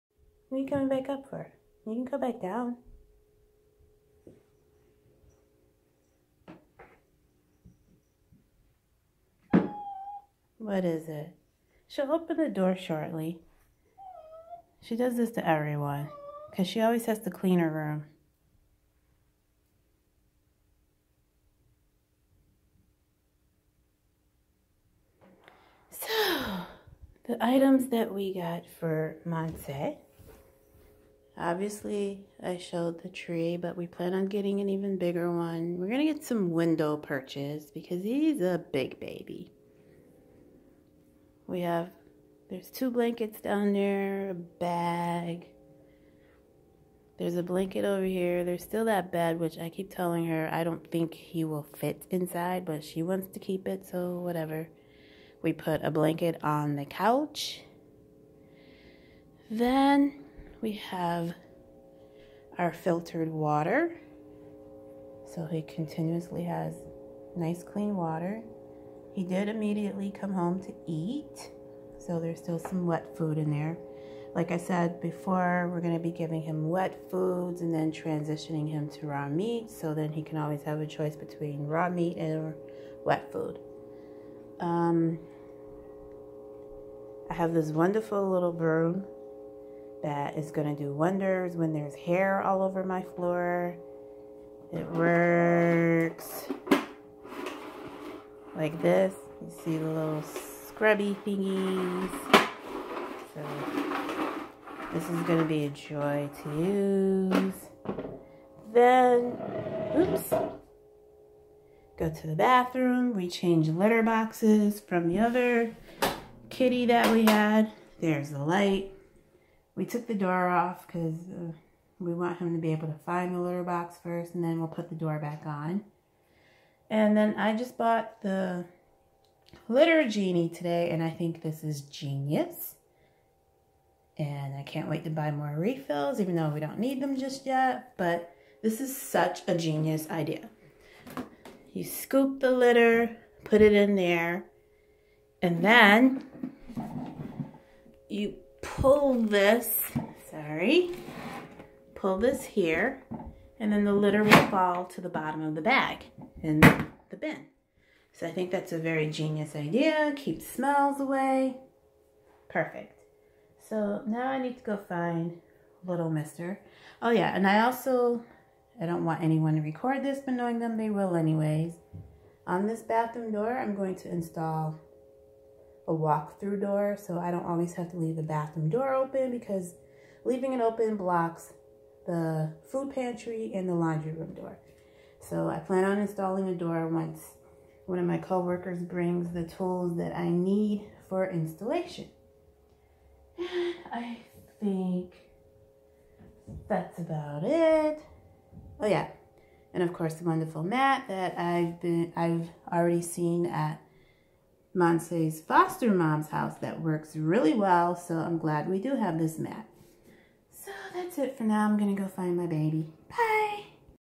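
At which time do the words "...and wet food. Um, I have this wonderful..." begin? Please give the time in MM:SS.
01:22.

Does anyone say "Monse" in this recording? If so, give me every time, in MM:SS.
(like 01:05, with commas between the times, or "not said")
00:29, 03:24.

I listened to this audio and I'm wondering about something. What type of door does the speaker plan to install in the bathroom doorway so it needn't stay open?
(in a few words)
Walk-through door.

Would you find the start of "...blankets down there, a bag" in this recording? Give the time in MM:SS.
00:42.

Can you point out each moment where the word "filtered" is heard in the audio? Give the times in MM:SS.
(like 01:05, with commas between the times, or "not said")
01:02.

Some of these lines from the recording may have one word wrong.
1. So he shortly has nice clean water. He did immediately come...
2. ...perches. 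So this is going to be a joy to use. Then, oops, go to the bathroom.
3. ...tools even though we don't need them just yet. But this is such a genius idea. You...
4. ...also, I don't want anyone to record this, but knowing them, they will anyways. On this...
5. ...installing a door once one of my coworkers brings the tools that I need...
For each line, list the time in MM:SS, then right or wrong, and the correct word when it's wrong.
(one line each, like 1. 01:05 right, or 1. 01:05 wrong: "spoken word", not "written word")
1. 01:05 wrong: "continuously", not "shortly"
2. 01:41 wrong: "thingies", not "perches"
3. 02:15 wrong: "refills", not "tools"
4. 02:47 right
5. 03:05 right.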